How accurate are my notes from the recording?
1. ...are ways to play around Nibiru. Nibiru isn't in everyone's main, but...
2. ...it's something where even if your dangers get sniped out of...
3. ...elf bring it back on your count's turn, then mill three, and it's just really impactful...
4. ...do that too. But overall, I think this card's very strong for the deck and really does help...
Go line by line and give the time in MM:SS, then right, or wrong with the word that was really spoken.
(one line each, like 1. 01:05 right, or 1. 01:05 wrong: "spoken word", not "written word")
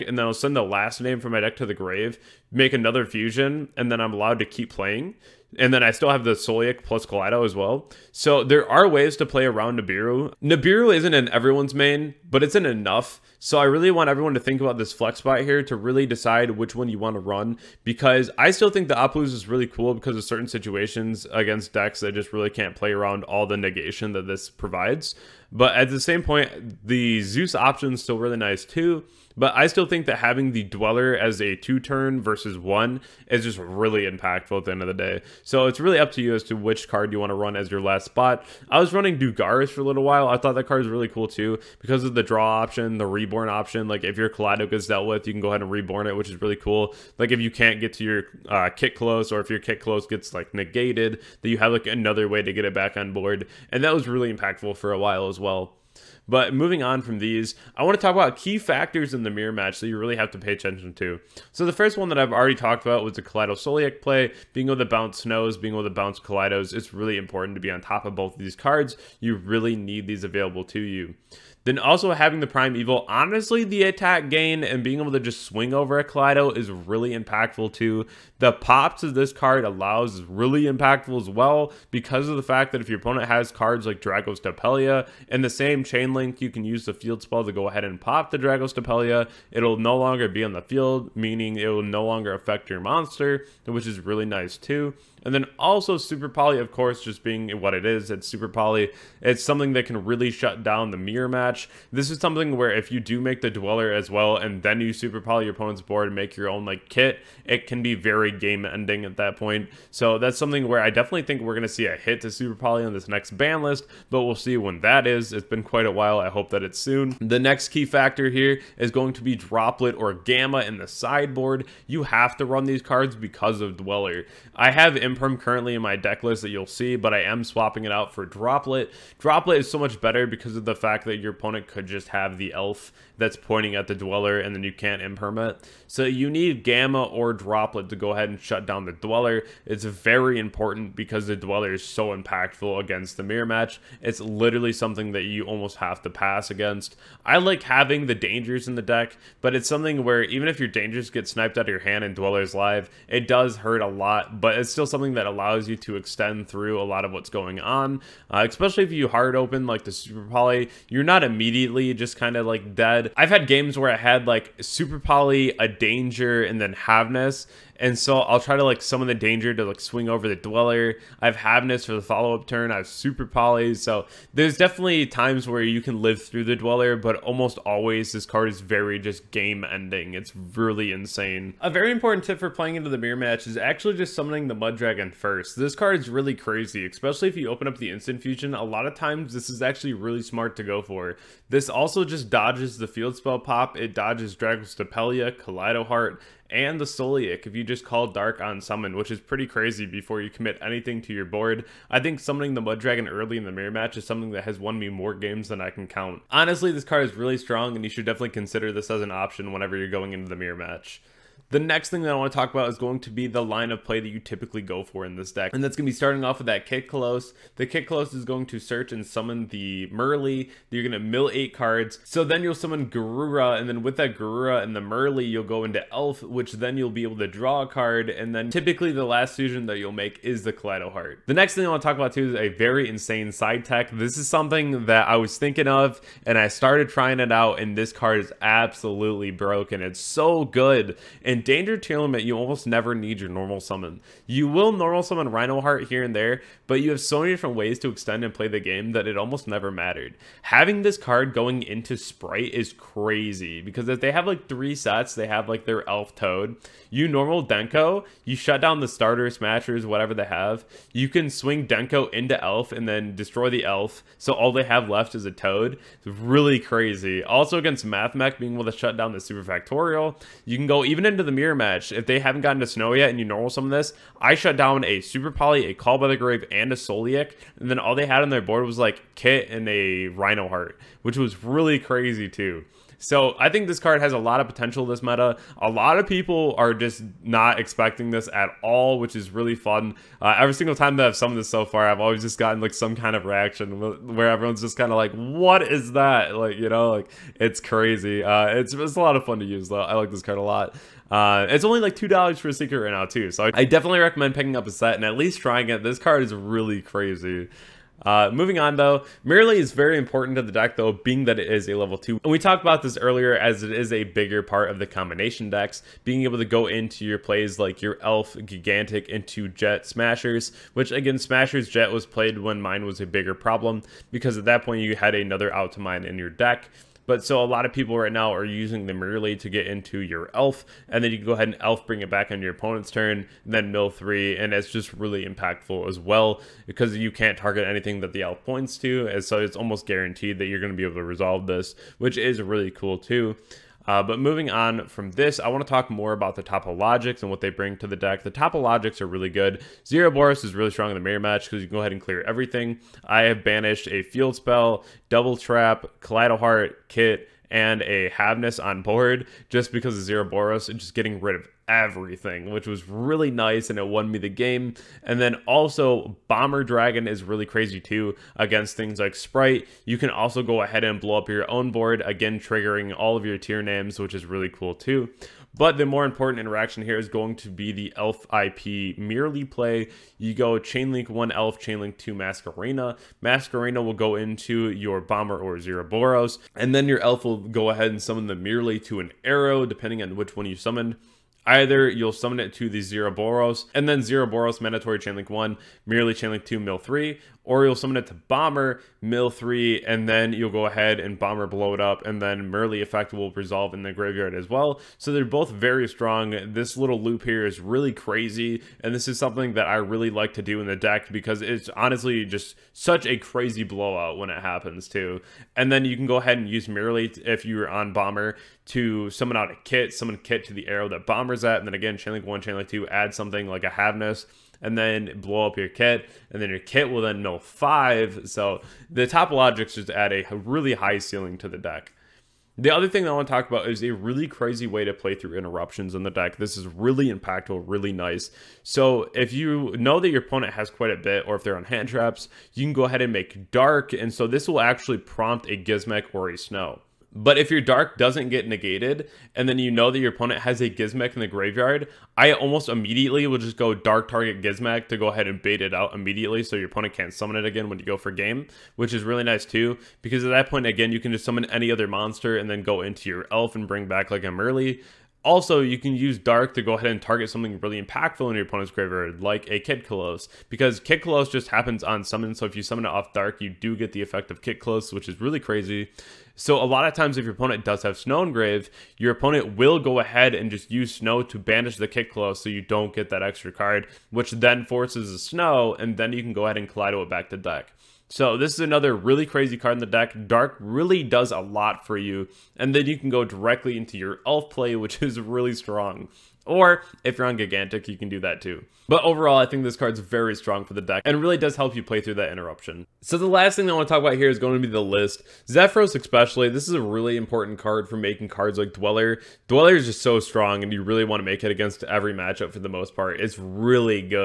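1. 00:08 right
2. 02:29 right
3. 05:31 wrong: "opponent", not "count"
4. 08:18 right.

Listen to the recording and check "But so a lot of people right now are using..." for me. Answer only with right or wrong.
right.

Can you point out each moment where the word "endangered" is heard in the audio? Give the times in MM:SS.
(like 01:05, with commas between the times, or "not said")
04:01.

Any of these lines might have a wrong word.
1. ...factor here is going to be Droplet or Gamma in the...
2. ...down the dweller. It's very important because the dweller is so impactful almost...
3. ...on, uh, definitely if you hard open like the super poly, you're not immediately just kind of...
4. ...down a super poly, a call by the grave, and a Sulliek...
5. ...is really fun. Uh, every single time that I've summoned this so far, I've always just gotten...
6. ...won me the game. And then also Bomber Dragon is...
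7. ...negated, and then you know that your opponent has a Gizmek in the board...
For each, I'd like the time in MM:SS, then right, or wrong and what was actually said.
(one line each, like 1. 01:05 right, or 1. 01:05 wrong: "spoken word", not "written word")
1. 01:57 right
2. 02:18 wrong: "against", not "almost"
3. 02:37 wrong: "especially", not "definitely"
4. 04:34 right
5. 04:49 right
6. 06:03 right
7. 07:28 wrong: "graveyard", not "board".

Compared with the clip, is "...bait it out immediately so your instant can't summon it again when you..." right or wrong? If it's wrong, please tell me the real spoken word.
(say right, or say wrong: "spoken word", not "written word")
wrong: "opponent", not "instant".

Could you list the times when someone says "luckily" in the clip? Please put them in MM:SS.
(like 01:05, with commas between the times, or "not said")
not said.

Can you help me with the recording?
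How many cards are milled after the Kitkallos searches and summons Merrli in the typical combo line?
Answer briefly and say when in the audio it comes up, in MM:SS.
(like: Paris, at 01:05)
8, at 03:41.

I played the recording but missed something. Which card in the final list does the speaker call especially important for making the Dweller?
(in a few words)
Zephyros.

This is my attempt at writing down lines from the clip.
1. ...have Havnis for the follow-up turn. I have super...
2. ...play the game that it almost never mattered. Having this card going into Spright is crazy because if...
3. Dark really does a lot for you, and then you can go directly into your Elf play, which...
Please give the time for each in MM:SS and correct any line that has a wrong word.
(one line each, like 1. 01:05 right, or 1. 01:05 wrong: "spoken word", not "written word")
1. 02:51 right
2. 04:08 right
3. 08:10 right.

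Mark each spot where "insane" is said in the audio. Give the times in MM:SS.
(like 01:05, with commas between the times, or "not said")
03:00, 03:52.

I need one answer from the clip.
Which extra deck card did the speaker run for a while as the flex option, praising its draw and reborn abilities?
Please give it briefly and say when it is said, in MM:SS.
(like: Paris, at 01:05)
Dugares, at 00:39.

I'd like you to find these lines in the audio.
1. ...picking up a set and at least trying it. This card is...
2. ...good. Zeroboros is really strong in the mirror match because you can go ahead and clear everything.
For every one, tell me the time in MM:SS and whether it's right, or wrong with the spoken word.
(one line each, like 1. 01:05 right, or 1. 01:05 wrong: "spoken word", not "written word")
1. 05:04 right
2. 05:49 right.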